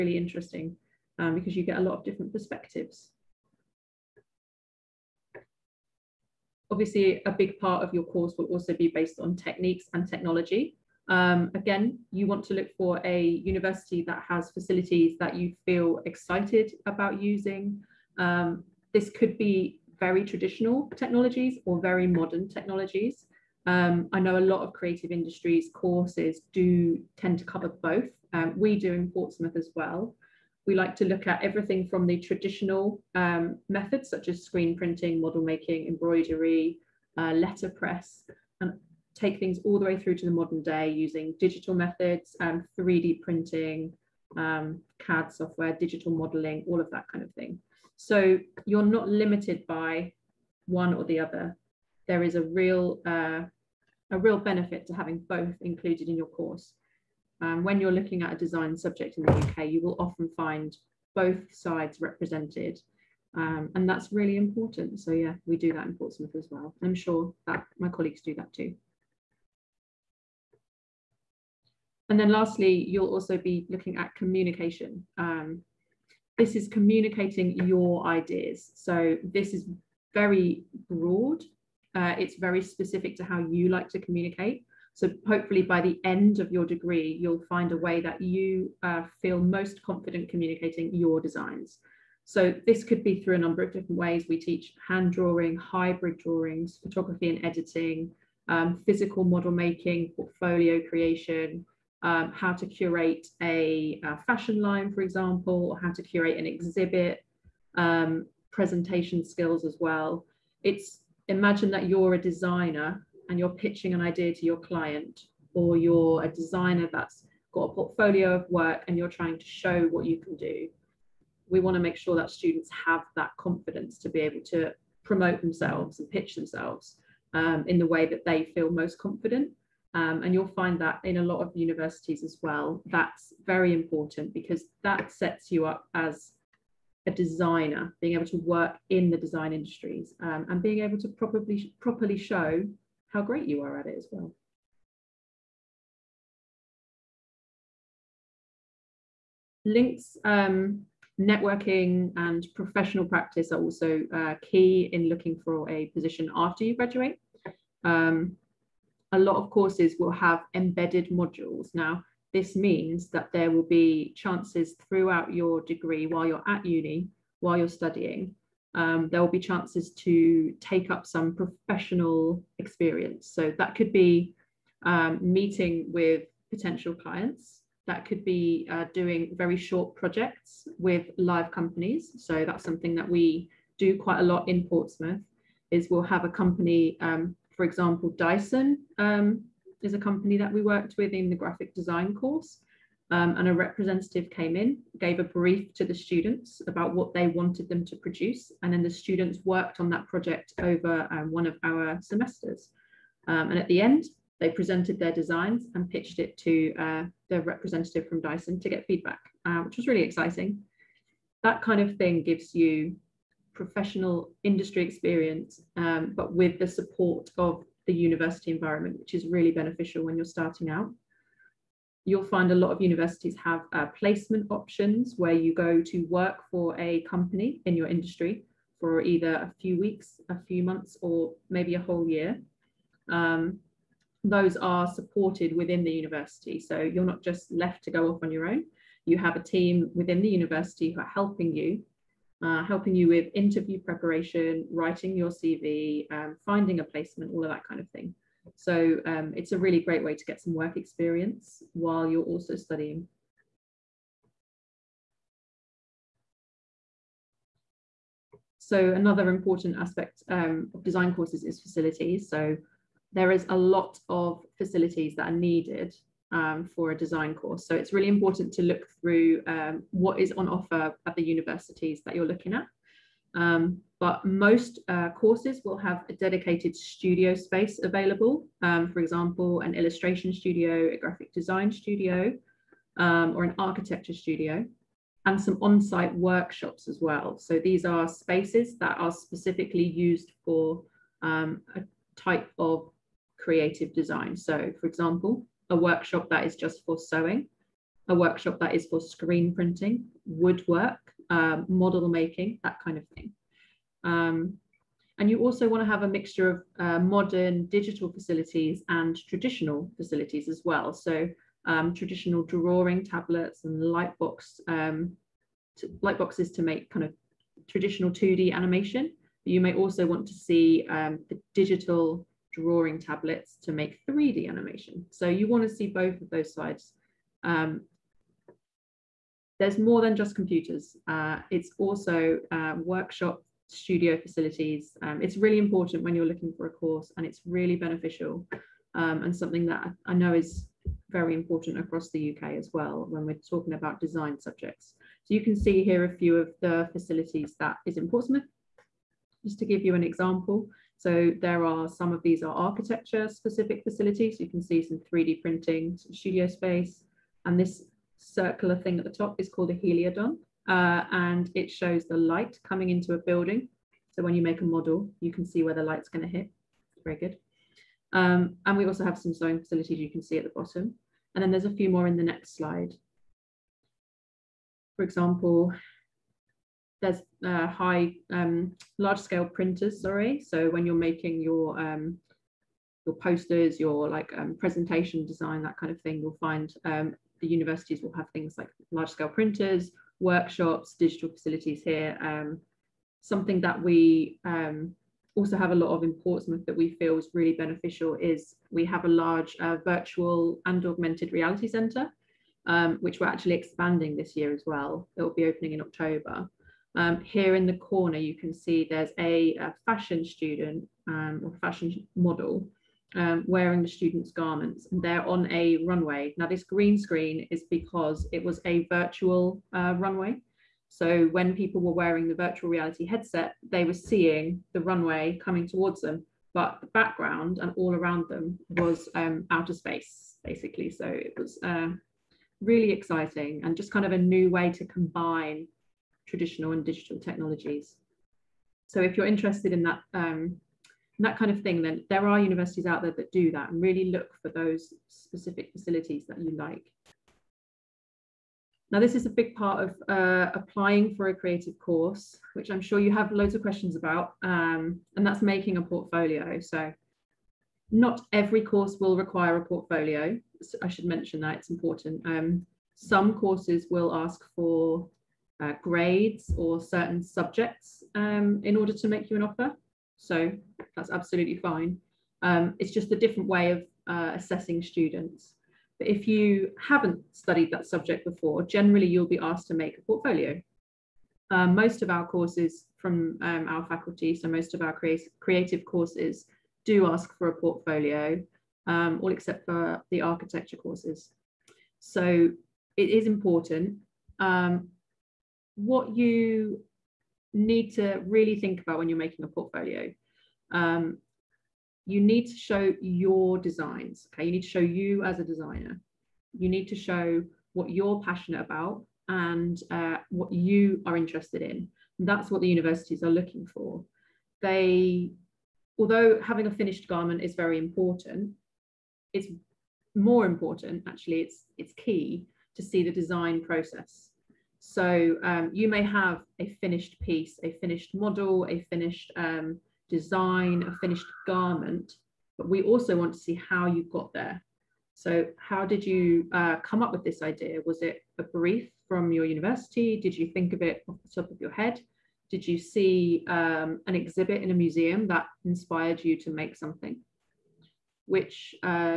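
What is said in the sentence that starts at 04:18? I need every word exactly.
So another important aspect um, of design courses is facilities.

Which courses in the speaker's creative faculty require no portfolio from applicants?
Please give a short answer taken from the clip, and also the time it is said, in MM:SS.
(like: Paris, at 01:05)
architecture courses, at 08:10.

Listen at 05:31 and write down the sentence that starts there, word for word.
Uh, it's also uh, workshop studio facilities.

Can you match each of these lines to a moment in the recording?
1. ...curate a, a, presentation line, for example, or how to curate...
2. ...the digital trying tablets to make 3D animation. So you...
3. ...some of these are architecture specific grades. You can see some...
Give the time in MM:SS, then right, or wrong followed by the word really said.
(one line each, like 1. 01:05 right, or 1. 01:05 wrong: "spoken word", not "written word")
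1. 01:42 wrong: "fashion", not "presentation"
2. 05:21 wrong: "drawing", not "trying"
3. 05:51 wrong: "facilities", not "grades".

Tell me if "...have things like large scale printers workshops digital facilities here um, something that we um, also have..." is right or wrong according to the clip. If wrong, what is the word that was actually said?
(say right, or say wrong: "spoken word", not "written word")
right.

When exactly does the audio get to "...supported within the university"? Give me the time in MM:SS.
03:54.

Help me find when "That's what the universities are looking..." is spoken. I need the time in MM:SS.
08:32.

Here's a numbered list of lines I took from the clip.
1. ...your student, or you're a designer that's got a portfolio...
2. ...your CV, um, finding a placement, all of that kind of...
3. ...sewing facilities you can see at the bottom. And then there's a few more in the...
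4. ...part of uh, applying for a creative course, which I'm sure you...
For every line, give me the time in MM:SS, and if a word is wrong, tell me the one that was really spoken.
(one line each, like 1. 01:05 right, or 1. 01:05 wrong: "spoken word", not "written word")
1. 01:54 wrong: "client", not "student"
2. 04:05 right
3. 06:09 right
4. 07:29 right.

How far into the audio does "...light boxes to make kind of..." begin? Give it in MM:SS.
05:16.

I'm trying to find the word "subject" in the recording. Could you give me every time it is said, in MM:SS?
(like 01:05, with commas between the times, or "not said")
00:58, 05:44, 07:47, 07:57.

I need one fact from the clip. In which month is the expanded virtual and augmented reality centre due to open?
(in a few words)
October.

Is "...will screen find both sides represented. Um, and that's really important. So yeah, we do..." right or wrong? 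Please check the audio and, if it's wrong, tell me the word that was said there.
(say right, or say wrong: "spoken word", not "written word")
wrong: "often", not "screen".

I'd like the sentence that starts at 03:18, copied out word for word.
And then the students worked on that project over um, one of our semesters.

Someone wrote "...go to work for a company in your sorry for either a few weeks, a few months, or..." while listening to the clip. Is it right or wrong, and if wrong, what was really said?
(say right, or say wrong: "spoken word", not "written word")
wrong: "industry", not "sorry".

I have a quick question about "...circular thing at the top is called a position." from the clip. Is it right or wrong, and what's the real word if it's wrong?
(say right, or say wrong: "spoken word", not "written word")
wrong: "heliodon", not "position".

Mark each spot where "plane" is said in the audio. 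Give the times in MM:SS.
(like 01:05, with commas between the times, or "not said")
not said.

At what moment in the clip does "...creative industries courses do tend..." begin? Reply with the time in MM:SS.
00:24.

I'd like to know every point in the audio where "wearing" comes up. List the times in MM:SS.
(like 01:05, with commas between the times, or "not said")
06:53, 07:01.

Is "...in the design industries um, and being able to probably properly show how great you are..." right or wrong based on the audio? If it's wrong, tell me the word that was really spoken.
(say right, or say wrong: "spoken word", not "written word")
right.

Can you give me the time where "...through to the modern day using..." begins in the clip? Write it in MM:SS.
00:39.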